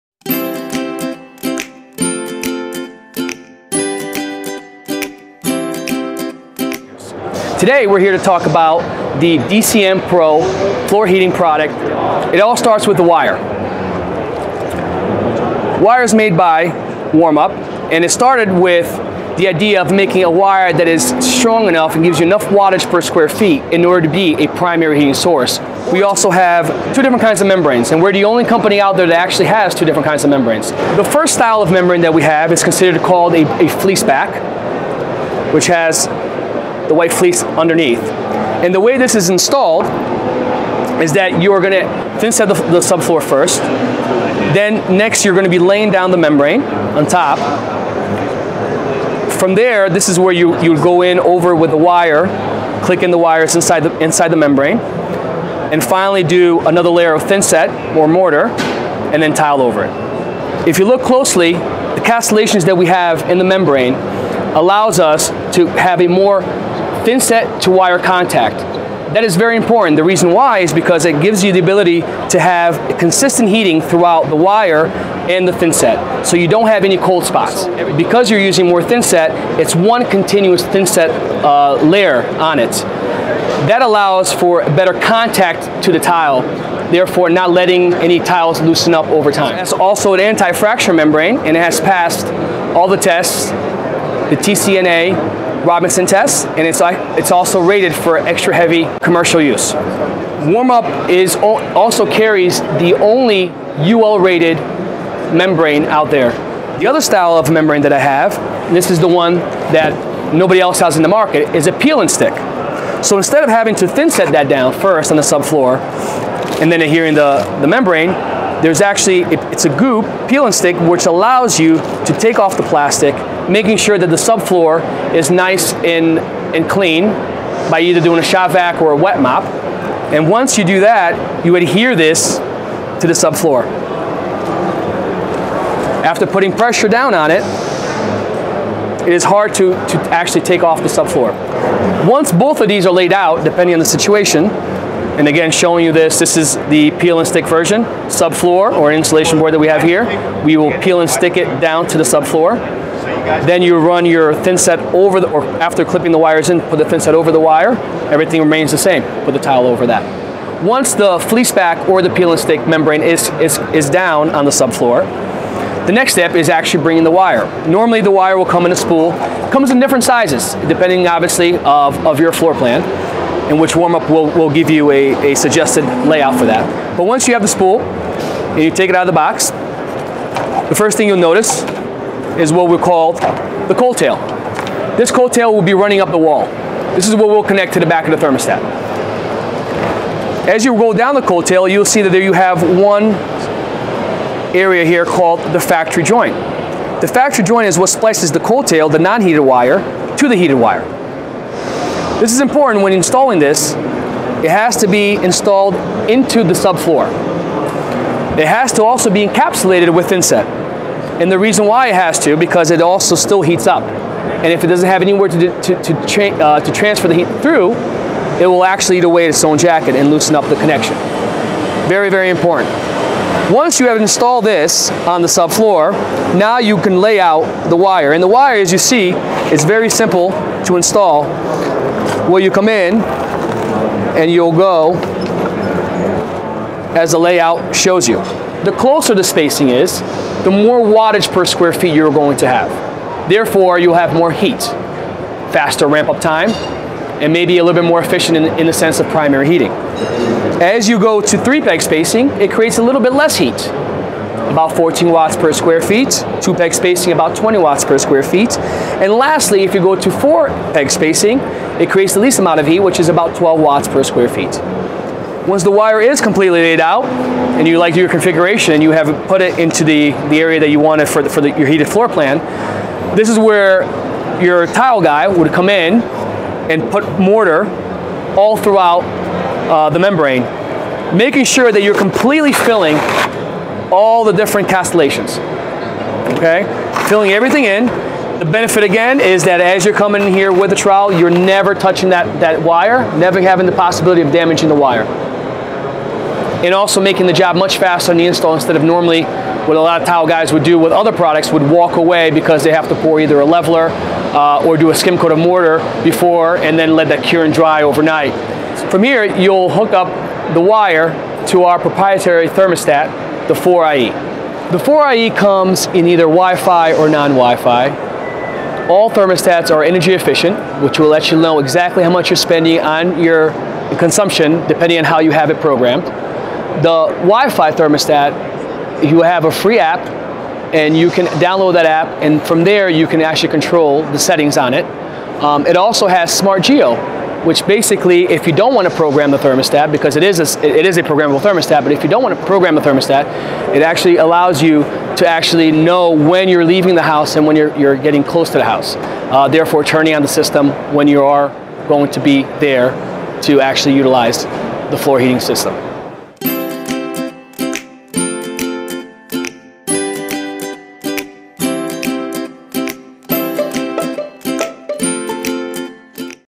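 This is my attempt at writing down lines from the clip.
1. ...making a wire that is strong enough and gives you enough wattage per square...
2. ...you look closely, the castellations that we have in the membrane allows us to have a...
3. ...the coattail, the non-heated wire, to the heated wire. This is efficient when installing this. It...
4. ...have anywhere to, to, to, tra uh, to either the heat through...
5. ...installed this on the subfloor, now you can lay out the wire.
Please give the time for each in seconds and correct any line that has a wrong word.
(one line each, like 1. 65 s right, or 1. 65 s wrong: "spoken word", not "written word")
1. 19 s right
2. 60 s right
3. 198 s wrong: "important", not "efficient"
4. 214 s wrong: "transfer", not "either"
5. 224 s right.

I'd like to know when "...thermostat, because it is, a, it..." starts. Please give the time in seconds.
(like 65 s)
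339 s.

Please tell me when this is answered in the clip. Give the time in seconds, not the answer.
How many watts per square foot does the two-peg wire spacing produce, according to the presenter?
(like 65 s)
257 s.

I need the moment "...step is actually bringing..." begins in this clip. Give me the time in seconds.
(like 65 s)
166 s.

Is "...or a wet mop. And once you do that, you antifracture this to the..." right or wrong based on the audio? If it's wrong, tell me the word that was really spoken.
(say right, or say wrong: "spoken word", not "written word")
wrong: "adhere", not "antifracture".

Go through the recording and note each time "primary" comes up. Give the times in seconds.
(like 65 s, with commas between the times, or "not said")
24 s, 249 s.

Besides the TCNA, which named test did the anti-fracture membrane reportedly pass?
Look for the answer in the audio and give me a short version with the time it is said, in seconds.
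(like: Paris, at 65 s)
Robinson test, at 95 s.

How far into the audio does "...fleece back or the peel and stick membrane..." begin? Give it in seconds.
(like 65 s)
161 s.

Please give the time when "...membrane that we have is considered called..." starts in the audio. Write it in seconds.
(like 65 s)
31 s.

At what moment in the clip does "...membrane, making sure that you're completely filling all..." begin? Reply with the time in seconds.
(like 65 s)
279 s.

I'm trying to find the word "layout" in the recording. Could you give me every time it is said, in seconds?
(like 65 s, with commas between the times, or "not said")
176 s, 237 s.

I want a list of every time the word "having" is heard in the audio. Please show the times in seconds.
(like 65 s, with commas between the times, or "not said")
113 s, 293 s.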